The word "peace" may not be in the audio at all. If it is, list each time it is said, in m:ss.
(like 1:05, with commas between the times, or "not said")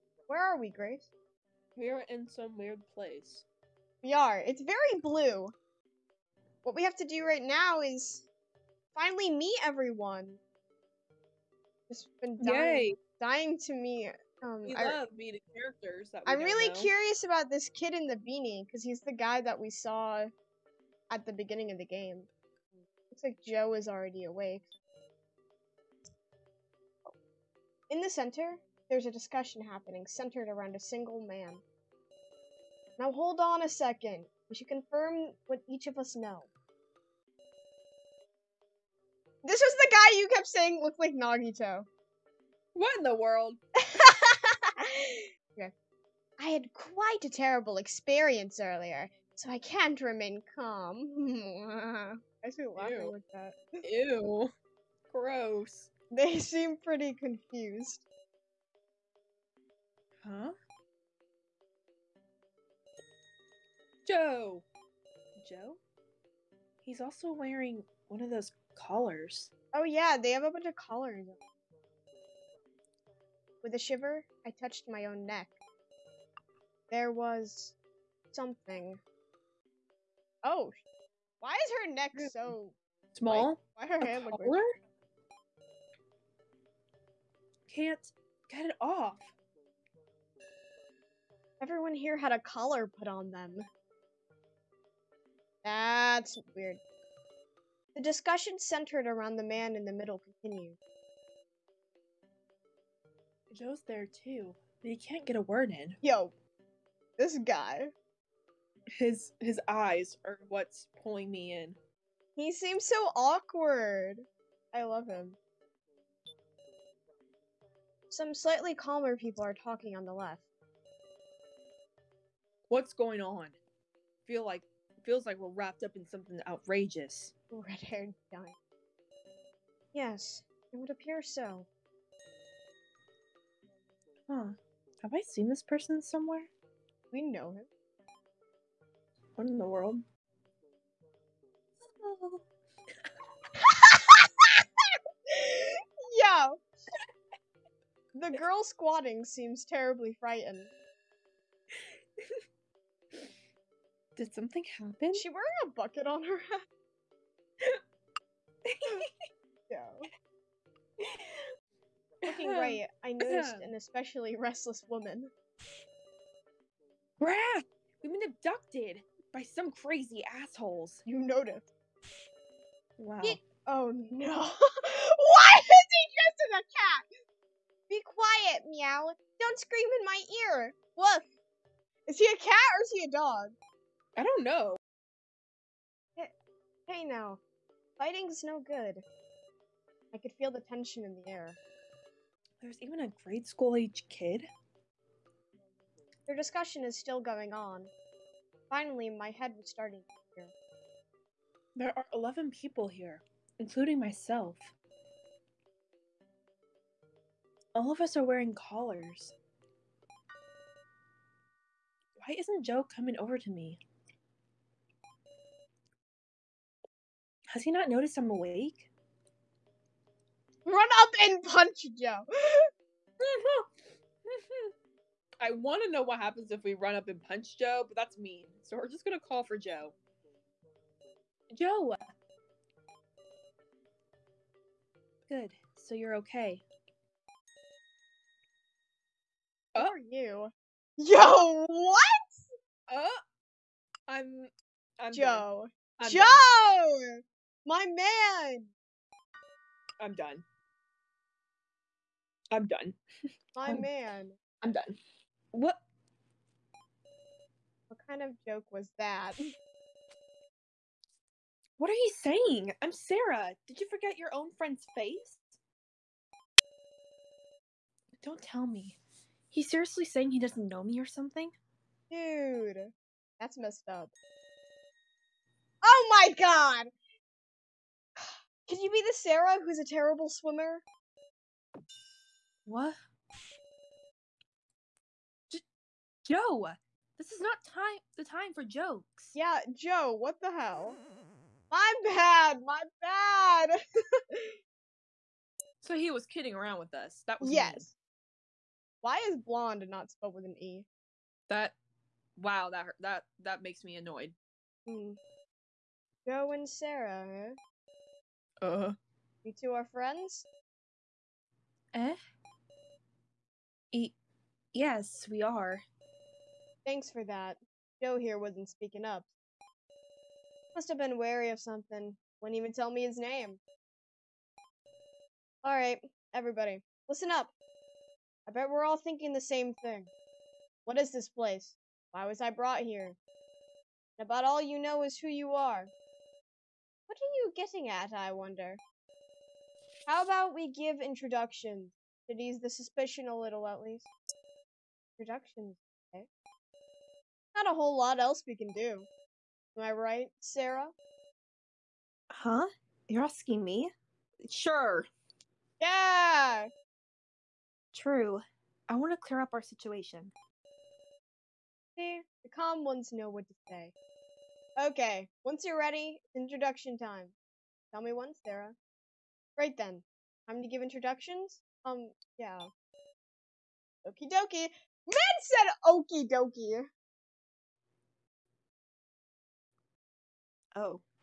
not said.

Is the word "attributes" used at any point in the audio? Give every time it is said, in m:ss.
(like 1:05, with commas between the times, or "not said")
not said.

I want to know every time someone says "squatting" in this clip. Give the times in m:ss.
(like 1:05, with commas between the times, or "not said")
2:28.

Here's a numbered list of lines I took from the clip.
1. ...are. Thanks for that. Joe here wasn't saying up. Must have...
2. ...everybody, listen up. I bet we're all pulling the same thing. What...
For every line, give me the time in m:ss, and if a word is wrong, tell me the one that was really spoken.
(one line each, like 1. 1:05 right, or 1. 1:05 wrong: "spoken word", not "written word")
1. 5:15 wrong: "speaking", not "saying"
2. 5:26 wrong: "thinking", not "pulling".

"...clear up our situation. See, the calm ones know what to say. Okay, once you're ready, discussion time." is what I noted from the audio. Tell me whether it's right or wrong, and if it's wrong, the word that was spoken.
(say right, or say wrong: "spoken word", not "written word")
wrong: "introduction", not "discussion".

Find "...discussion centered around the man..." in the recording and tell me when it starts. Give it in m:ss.
1:38.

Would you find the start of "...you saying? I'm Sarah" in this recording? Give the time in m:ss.
4:21.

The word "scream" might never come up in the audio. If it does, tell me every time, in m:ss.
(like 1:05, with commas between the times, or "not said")
2:59.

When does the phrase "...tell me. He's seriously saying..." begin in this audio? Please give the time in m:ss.
4:28.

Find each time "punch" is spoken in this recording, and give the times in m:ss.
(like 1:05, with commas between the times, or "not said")
3:41, 3:47.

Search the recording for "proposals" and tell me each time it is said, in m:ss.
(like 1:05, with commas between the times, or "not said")
not said.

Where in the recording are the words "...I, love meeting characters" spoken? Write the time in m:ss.
0:14.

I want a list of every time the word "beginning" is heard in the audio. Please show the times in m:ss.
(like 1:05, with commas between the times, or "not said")
0:21.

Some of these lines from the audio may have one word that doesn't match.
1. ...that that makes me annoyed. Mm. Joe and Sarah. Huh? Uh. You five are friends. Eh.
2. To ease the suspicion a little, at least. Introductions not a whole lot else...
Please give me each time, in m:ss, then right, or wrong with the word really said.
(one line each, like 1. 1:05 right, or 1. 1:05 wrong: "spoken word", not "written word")
1. 5:03 wrong: "two", not "five"
2. 5:42 right.